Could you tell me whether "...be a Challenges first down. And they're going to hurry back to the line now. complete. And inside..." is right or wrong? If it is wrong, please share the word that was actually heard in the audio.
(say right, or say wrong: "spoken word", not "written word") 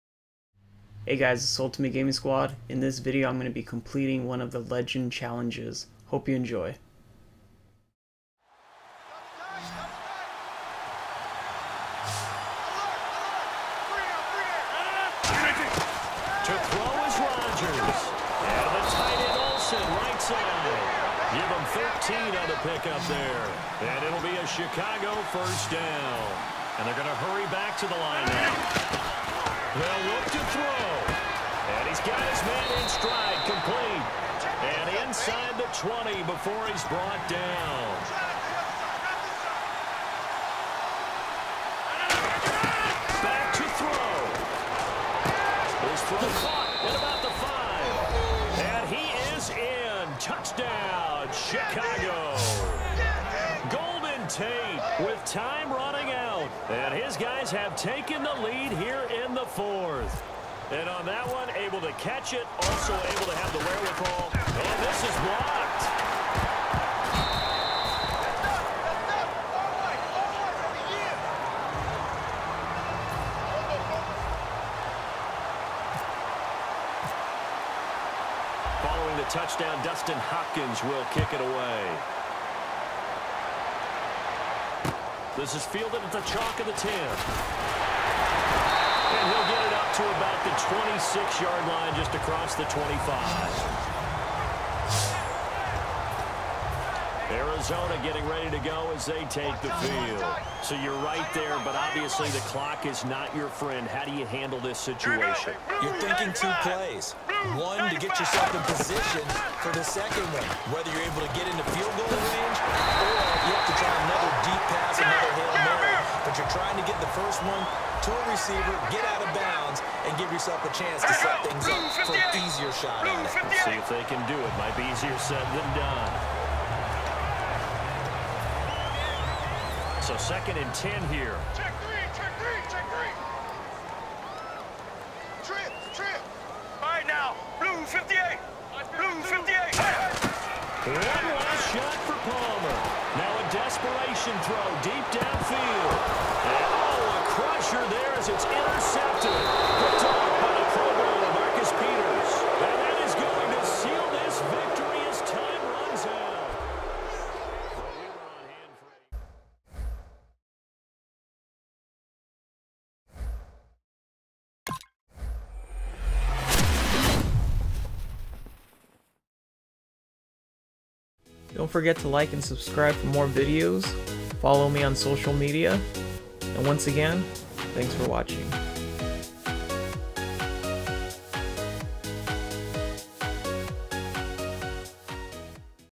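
wrong: "Chicago", not "Challenges".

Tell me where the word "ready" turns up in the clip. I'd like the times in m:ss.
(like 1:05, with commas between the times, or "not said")
1:38.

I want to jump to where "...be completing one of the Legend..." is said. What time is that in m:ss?
0:03.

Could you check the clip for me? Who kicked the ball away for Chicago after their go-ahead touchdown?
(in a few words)
Dustin Hopkins.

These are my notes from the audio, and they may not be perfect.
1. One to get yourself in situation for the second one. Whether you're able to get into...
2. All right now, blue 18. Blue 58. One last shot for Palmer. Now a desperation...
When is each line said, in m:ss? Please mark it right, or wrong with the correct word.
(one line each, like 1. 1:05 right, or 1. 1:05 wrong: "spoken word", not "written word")
1. 1:47 wrong: "position", not "situation"
2. 2:16 wrong: "58", not "18".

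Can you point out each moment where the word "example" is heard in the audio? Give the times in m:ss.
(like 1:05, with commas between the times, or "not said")
not said.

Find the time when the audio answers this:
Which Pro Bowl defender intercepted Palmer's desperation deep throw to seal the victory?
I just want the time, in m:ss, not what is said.
2:31.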